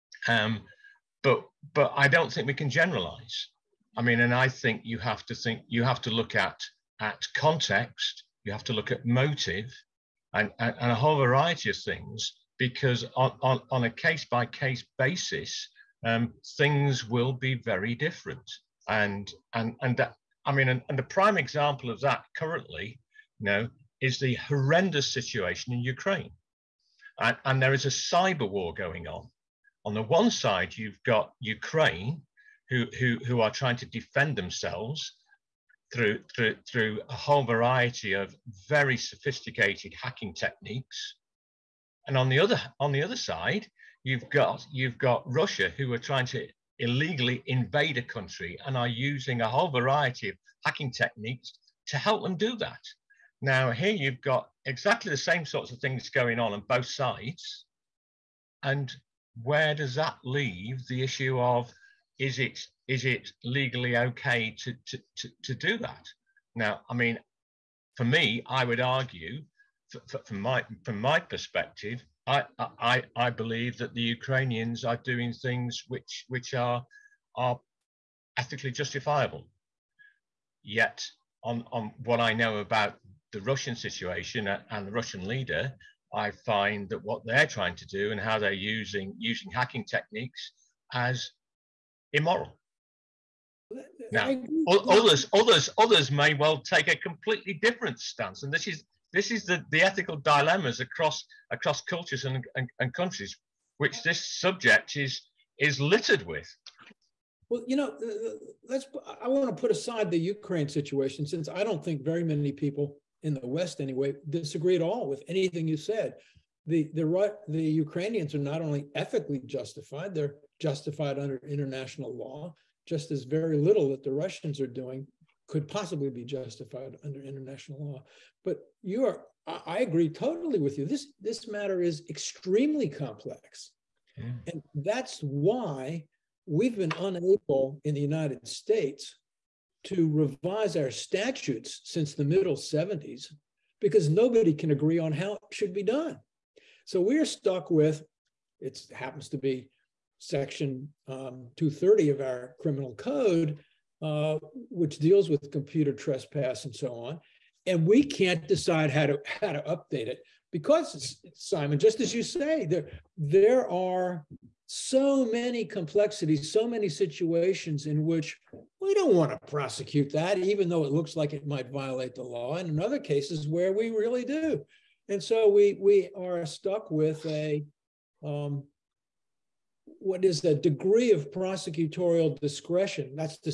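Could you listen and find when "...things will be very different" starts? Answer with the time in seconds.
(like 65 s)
16 s.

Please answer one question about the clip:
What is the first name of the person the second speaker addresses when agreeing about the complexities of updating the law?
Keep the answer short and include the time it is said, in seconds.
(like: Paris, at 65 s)
Simon, at 161 s.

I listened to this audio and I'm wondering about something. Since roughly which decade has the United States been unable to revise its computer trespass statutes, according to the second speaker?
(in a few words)
the 70s.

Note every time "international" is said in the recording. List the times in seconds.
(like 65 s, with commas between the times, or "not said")
121 s, 127 s.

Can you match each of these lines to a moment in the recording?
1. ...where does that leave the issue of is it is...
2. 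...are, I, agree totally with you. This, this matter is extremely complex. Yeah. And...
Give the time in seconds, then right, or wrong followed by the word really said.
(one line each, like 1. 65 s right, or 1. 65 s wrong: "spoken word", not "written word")
1. 59 s right
2. 129 s right.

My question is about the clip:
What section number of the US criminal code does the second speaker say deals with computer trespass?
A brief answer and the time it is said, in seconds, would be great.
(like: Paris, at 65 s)
230, at 151 s.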